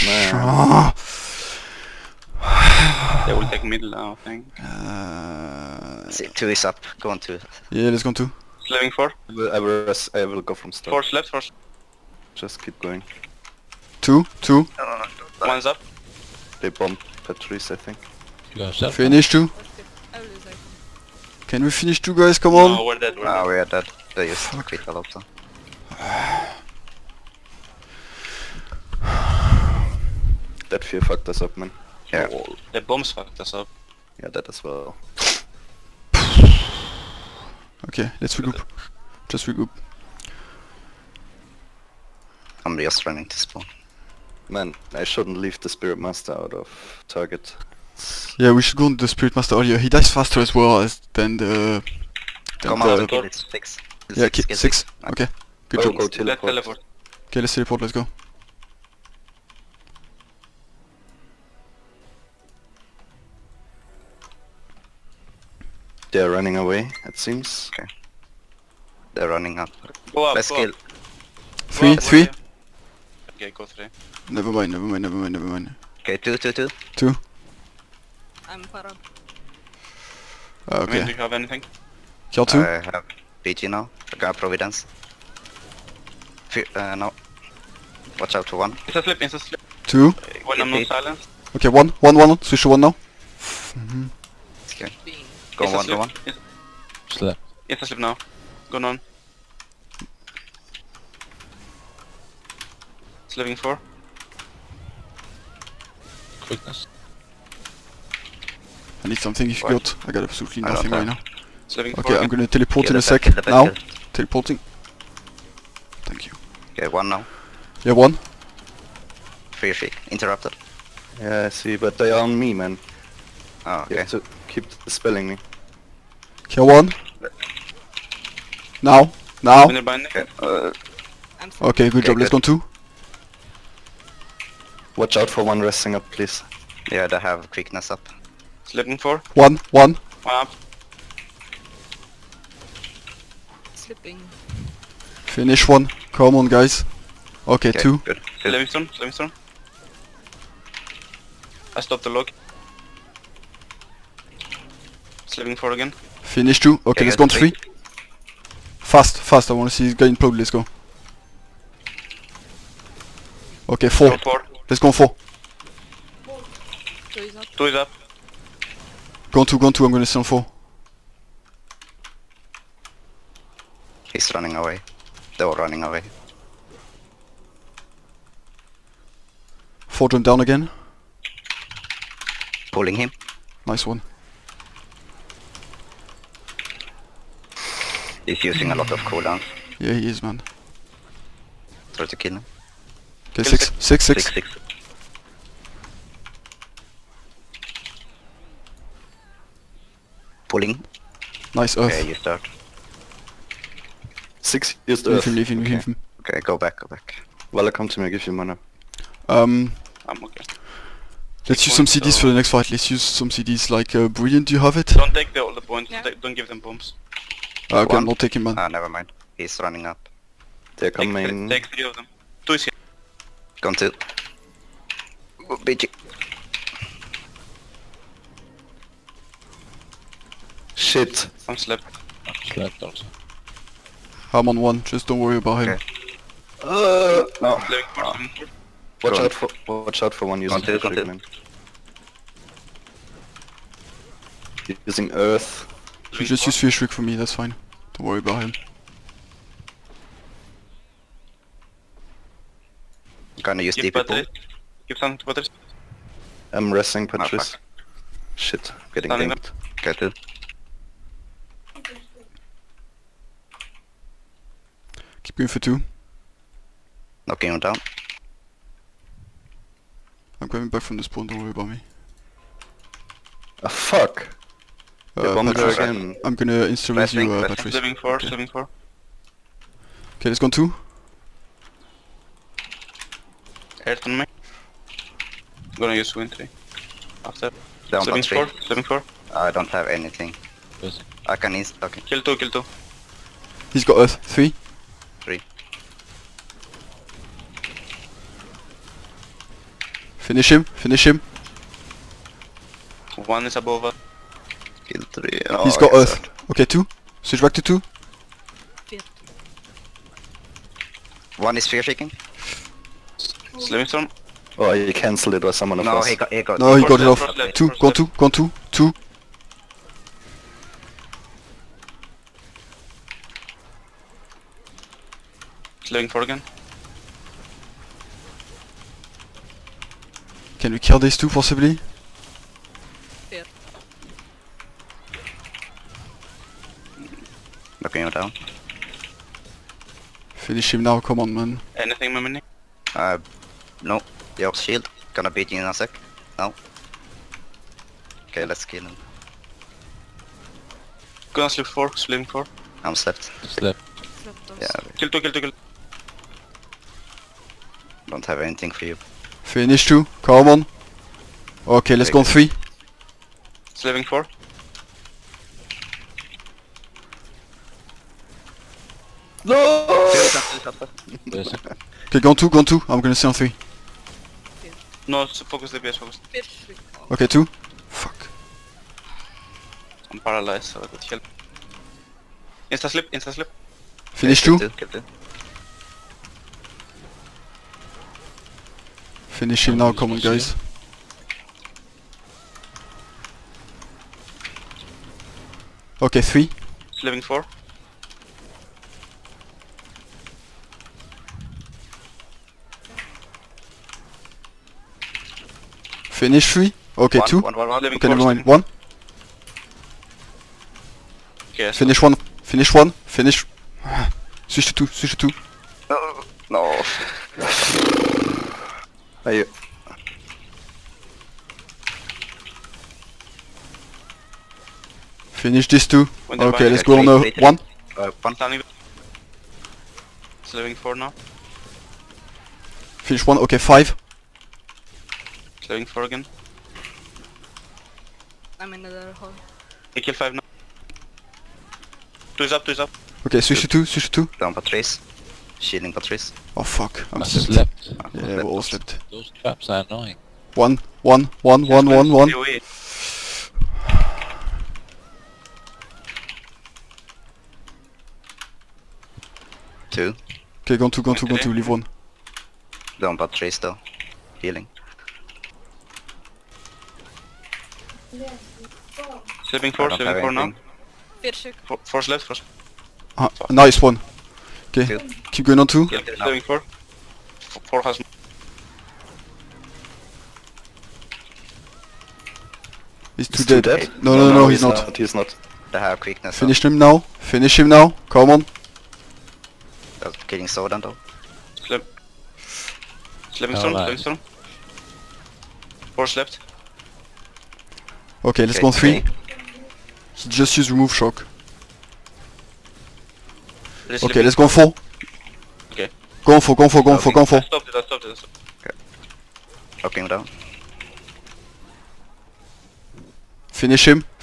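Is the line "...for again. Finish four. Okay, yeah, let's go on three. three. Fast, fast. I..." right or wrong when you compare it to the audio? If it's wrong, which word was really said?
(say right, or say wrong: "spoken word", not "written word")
wrong: "two", not "four".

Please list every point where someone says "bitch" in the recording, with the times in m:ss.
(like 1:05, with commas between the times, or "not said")
3:45.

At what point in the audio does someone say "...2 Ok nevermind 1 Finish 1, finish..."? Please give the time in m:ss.
6:47.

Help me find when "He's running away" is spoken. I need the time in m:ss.
2:54.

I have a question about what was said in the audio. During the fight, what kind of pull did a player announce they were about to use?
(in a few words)
DP pull.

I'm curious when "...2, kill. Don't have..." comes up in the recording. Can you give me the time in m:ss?
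5:55.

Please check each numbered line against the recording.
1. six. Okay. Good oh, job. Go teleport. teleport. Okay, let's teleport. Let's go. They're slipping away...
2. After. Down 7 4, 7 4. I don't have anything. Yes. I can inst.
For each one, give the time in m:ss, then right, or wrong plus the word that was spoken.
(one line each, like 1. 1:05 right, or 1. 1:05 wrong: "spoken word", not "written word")
1. 0:54 wrong: "running", not "slipping"
2. 4:47 right.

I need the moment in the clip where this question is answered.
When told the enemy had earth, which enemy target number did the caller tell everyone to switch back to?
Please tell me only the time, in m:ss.
5:07.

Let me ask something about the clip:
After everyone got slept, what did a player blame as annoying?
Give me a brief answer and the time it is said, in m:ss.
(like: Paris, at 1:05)
Traps, at 7:29.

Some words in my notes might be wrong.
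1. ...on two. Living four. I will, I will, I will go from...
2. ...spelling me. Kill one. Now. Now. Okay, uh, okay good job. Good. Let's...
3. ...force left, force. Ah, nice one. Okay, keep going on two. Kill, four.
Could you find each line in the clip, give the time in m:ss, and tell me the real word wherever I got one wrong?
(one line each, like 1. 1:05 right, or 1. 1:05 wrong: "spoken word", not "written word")
1. 0:08 right
2. 2:04 right
3. 7:51 right.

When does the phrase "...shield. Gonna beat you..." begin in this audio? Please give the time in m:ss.
5:44.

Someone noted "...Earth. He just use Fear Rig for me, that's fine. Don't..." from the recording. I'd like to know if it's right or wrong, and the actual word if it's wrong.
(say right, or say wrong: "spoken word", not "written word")
right.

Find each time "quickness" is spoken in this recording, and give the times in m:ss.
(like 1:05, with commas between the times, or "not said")
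1:46, 2:17, 8:05.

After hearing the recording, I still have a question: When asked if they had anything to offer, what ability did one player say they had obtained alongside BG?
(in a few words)
Providence.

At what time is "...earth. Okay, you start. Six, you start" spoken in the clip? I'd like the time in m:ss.
3:21.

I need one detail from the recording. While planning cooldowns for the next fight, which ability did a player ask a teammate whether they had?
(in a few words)
Brilliant.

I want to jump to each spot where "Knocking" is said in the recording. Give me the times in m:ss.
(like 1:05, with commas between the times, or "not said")
4:27, 5:37.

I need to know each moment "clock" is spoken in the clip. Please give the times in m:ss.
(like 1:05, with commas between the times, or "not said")
not said.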